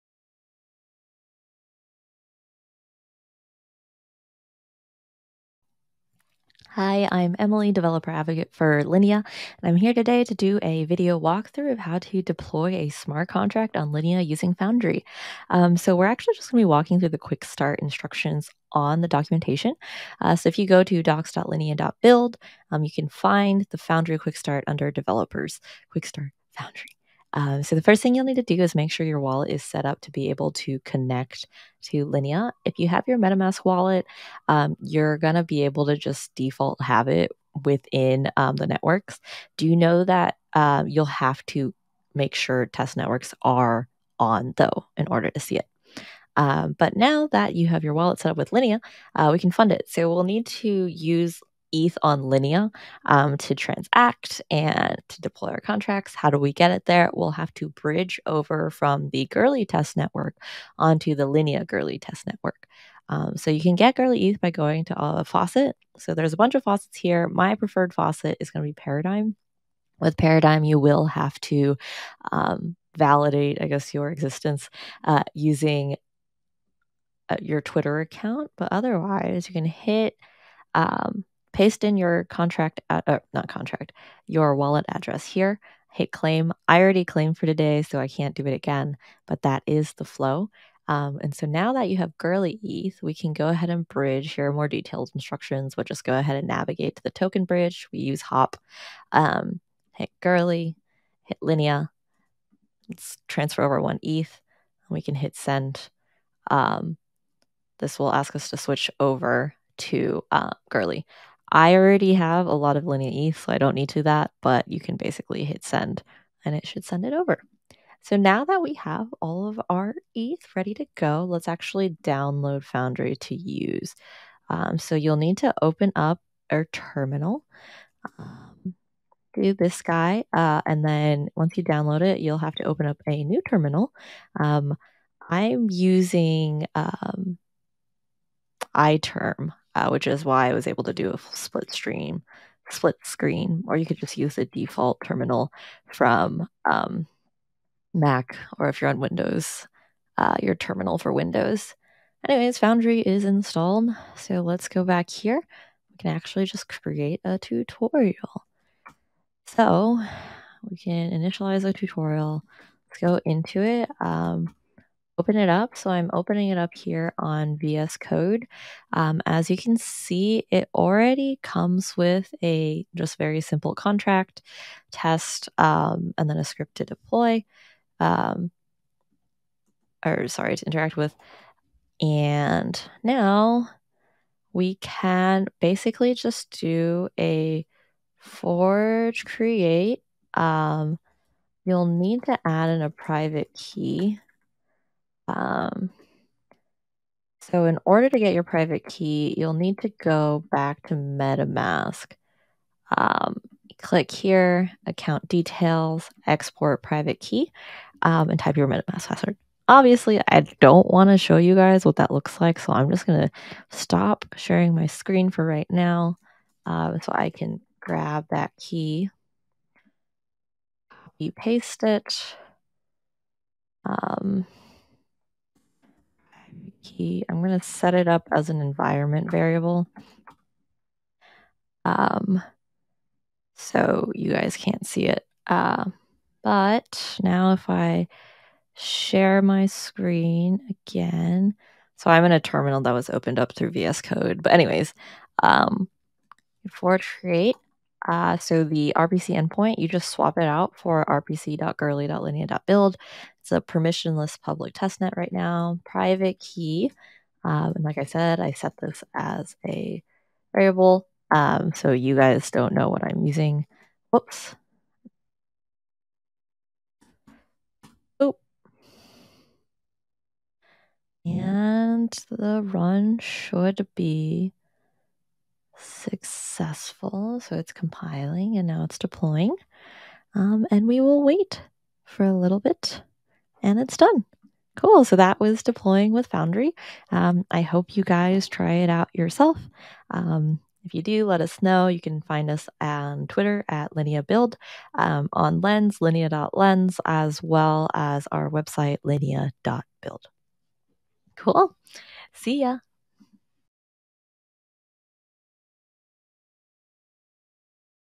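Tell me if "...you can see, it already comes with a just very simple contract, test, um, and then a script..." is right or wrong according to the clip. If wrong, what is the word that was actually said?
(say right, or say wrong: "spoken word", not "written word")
right.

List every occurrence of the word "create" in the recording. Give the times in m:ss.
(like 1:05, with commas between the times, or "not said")
2:36, 3:09, 4:07.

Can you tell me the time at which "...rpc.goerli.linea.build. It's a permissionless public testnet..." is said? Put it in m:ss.
4:11.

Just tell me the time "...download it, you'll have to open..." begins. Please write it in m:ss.
2:11.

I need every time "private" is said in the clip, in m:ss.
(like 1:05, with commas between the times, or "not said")
3:12, 3:18, 3:26, 4:15.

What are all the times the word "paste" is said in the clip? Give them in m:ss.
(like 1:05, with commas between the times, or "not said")
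1:21, 3:41.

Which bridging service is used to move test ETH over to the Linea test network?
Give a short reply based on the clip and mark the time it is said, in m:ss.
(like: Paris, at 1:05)
Hop, at 1:38.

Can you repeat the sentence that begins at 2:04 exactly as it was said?
Um, so you'll need to open up our terminal.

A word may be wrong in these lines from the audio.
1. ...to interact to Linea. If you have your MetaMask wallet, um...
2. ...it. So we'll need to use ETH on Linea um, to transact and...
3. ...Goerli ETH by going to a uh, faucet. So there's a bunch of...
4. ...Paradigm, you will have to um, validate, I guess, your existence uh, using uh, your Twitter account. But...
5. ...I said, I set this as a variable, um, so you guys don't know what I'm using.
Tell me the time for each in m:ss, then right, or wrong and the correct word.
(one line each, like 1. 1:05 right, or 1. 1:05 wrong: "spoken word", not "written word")
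1. 0:30 wrong: "connect", not "interact"
2. 0:49 right
3. 1:03 right
4. 1:10 right
5. 4:17 right.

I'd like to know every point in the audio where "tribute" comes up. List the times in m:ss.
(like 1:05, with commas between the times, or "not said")
not said.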